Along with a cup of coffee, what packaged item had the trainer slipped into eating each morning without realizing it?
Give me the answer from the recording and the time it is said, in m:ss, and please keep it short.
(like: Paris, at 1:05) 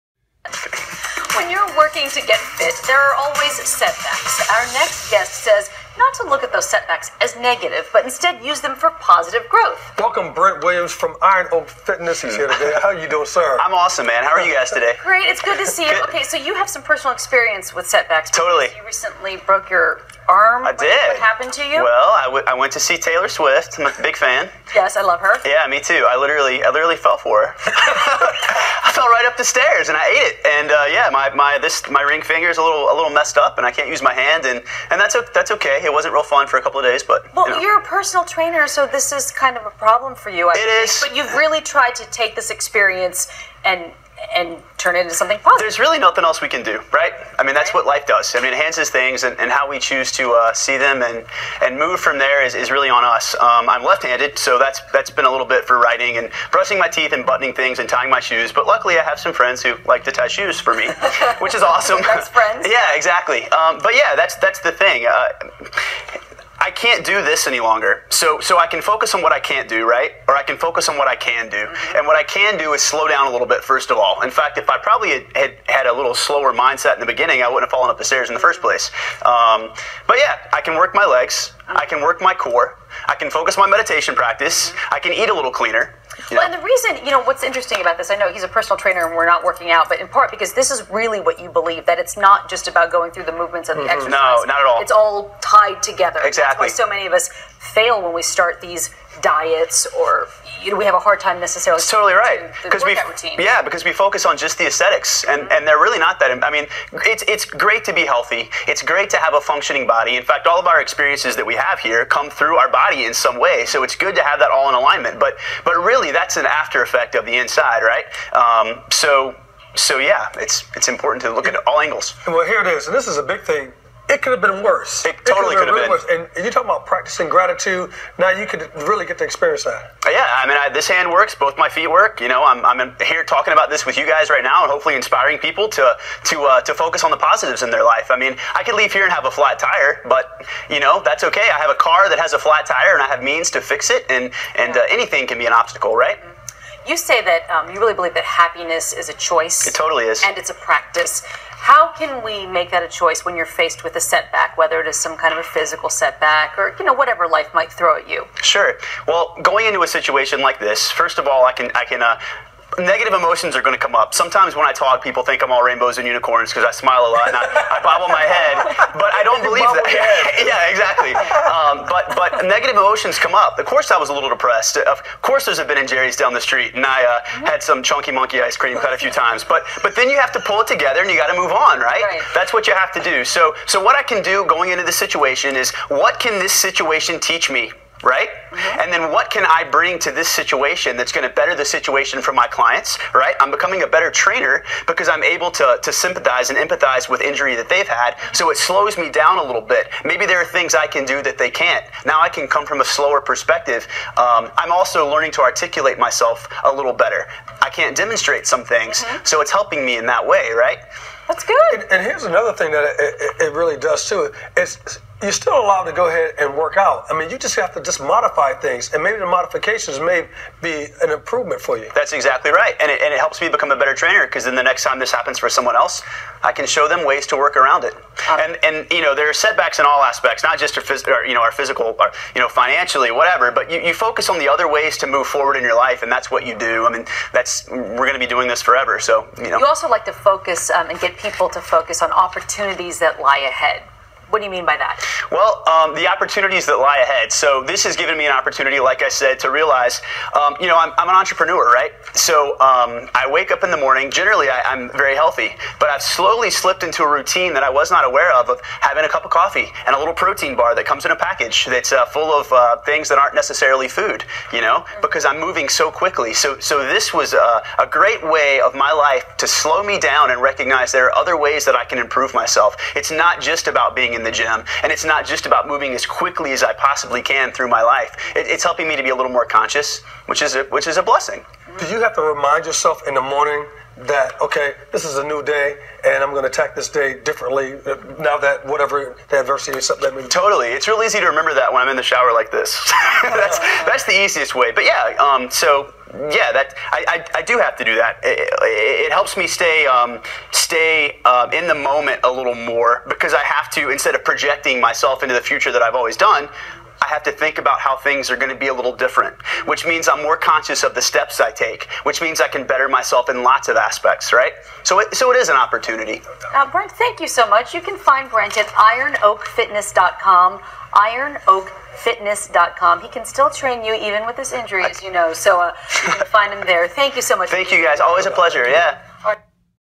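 Protein bar, at 4:20.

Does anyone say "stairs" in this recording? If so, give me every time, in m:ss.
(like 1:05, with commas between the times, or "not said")
0:29, 1:18.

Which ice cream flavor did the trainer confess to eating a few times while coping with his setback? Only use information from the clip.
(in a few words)
Chunky Monkey.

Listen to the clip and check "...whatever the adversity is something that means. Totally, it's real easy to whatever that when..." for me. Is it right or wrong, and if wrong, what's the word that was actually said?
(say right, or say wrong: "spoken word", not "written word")
wrong: "remember", not "whatever".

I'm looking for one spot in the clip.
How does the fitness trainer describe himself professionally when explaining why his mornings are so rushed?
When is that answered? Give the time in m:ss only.
4:11.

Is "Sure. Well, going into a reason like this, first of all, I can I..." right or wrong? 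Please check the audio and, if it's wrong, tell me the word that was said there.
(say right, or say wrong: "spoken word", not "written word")
wrong: "situation", not "reason".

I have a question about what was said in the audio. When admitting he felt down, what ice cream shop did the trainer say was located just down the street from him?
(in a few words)
Ben and Jerry's.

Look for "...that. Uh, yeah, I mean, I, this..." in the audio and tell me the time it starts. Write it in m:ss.
2:09.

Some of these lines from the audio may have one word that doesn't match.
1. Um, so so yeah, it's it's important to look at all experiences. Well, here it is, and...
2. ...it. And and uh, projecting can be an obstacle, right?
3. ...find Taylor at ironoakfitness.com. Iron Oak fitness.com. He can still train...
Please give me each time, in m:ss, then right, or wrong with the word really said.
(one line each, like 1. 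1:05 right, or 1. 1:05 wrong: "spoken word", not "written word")
1. 1:58 wrong: "angles", not "experiences"
2. 2:23 wrong: "anything", not "projecting"
3. 5:17 wrong: "Brent", not "Taylor".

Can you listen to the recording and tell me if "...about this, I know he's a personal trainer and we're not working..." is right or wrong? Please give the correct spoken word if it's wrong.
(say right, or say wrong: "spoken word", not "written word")
right.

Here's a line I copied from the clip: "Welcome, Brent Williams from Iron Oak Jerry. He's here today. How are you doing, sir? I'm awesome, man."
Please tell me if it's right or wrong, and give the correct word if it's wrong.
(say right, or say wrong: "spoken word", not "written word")
wrong: "Fitness", not "Jerry".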